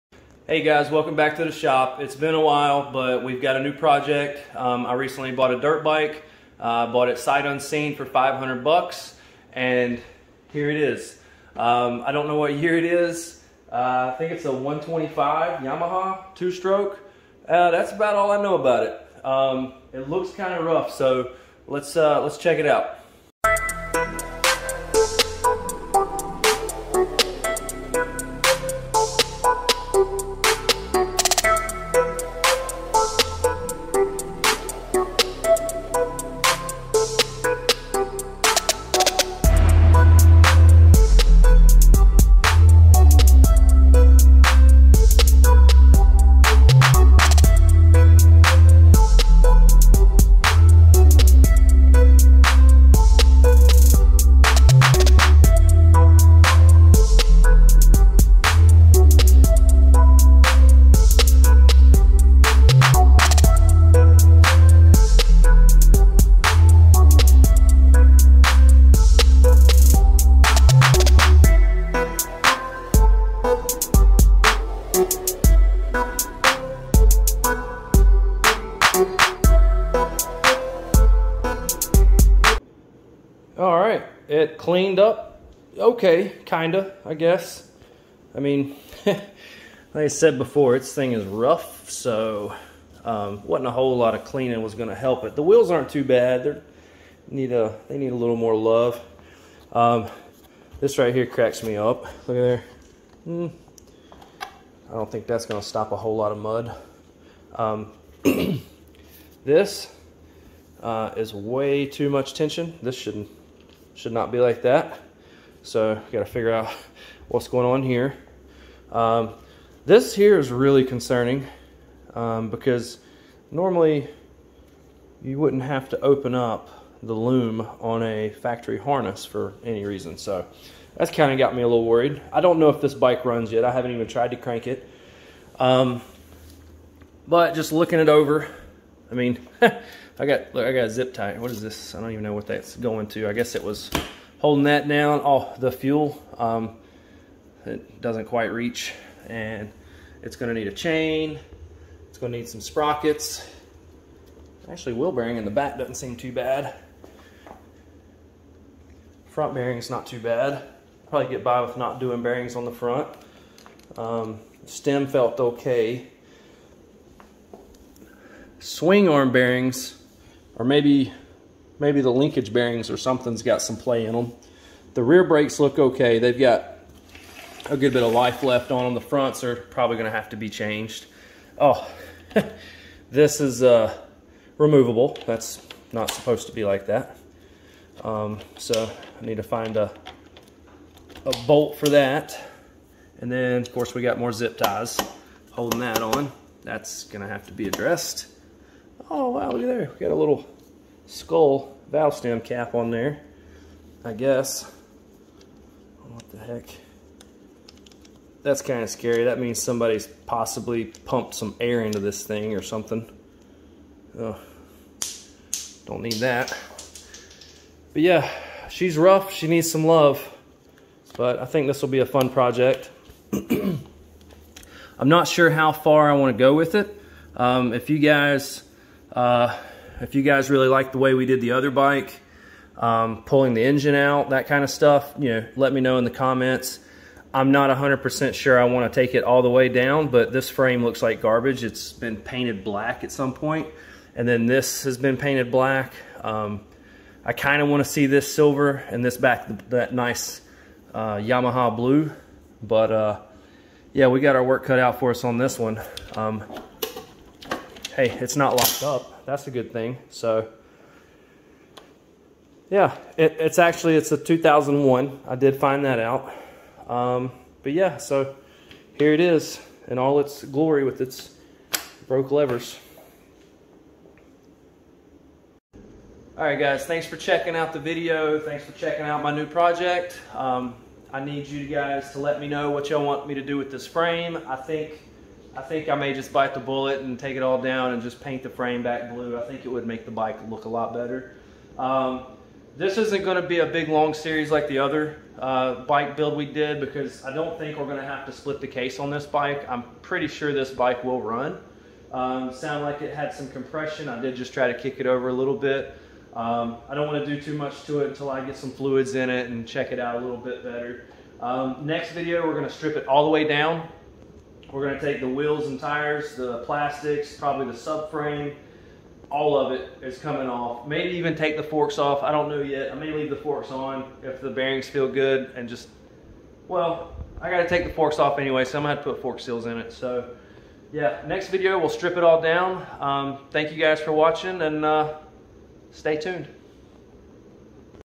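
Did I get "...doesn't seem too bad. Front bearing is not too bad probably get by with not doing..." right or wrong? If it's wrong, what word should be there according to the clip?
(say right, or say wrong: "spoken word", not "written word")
right.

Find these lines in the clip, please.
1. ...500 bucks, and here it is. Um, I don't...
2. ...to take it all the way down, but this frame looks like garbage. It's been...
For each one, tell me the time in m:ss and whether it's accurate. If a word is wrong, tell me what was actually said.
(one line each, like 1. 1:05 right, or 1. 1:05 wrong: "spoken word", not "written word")
1. 0:08 right
2. 3:58 right.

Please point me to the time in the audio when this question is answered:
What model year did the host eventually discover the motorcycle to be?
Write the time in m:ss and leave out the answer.
4:24.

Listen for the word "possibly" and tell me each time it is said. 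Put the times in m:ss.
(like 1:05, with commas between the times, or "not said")
3:30.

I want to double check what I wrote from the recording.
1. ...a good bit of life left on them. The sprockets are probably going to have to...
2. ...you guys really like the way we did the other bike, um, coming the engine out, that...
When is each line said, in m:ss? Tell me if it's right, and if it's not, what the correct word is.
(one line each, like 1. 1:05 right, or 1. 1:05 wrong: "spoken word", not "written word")
1. 2:57 wrong: "fronts", not "sprockets"
2. 3:50 wrong: "pulling", not "coming".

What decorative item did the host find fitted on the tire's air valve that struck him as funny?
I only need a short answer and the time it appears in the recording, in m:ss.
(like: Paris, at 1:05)
skull valve stem cap, at 3:21.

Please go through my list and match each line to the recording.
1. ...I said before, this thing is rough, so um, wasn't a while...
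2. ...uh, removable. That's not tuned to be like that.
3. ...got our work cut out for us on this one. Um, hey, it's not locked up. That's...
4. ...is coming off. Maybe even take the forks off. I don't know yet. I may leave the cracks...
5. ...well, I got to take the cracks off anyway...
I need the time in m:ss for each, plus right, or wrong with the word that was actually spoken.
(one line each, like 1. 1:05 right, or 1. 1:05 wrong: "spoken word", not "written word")
1. 1:29 wrong: "whole", not "while"
2. 3:03 wrong: "supposed", not "tuned"
3. 4:14 right
4. 5:20 wrong: "forks", not "cracks"
5. 5:26 wrong: "forks", not "cracks".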